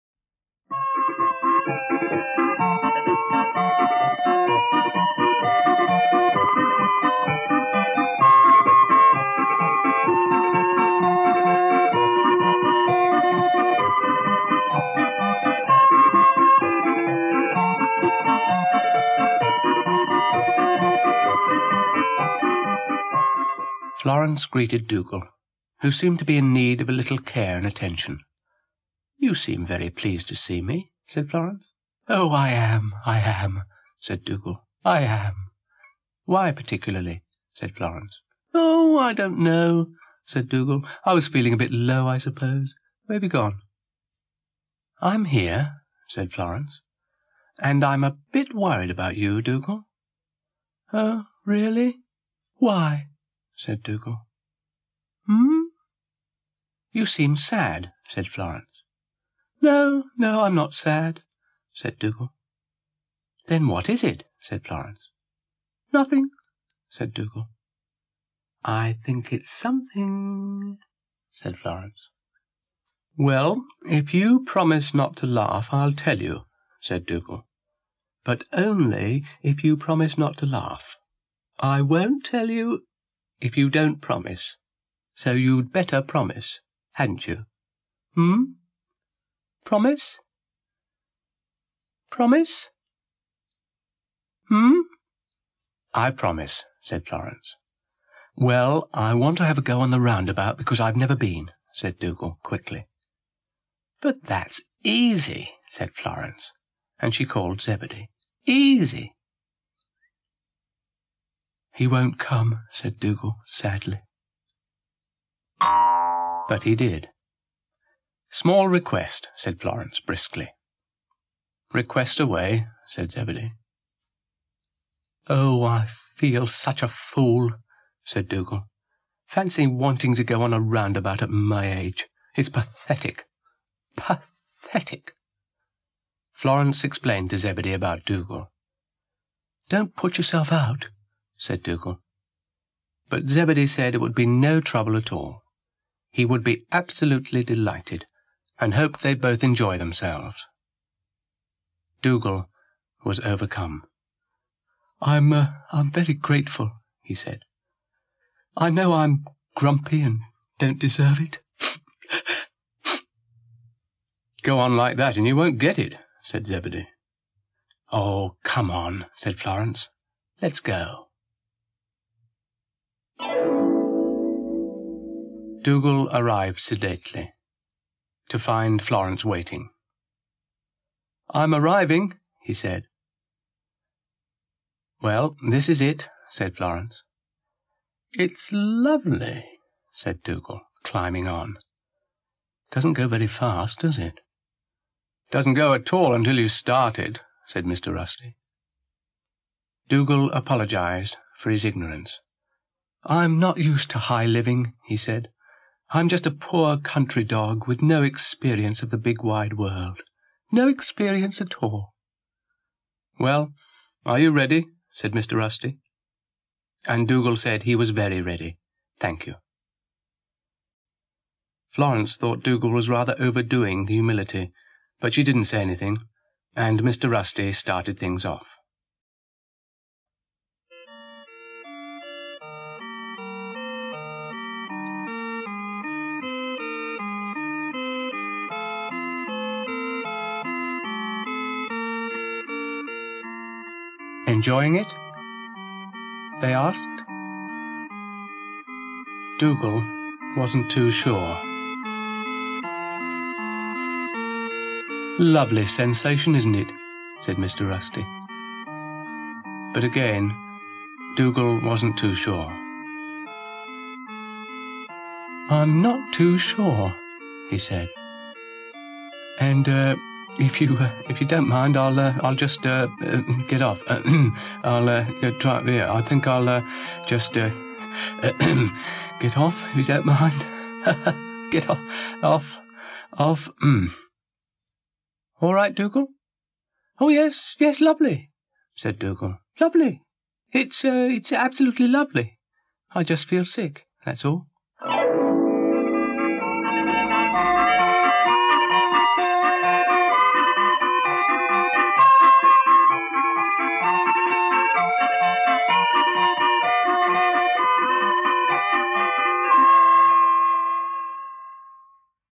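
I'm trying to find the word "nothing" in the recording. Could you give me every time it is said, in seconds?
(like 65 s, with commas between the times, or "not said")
65 s.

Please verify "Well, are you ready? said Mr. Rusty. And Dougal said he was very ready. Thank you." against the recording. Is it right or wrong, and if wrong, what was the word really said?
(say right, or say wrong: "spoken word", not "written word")
right.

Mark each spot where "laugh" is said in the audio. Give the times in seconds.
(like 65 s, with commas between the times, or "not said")
75 s, 80 s.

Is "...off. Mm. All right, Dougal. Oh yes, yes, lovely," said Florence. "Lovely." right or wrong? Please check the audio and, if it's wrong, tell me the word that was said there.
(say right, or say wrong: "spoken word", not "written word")
wrong: "Dougal", not "Florence".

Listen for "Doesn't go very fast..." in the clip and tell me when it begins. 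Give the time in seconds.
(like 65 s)
192 s.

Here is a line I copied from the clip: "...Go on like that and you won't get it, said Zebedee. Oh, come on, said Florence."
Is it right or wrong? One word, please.
right.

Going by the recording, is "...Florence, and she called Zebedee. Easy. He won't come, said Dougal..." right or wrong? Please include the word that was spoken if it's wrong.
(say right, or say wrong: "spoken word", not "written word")
right.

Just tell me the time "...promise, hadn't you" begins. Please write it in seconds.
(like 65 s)
86 s.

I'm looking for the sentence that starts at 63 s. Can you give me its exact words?
"Then what is it?" said Florence.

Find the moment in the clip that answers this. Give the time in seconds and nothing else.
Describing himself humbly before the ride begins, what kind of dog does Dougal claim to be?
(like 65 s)
206 s.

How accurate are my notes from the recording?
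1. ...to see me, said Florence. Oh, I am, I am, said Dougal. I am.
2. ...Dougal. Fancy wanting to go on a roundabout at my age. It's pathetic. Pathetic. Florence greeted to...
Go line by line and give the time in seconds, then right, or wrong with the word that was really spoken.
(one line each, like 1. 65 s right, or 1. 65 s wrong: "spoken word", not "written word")
1. 30 s right
2. 128 s wrong: "explained", not "greeted".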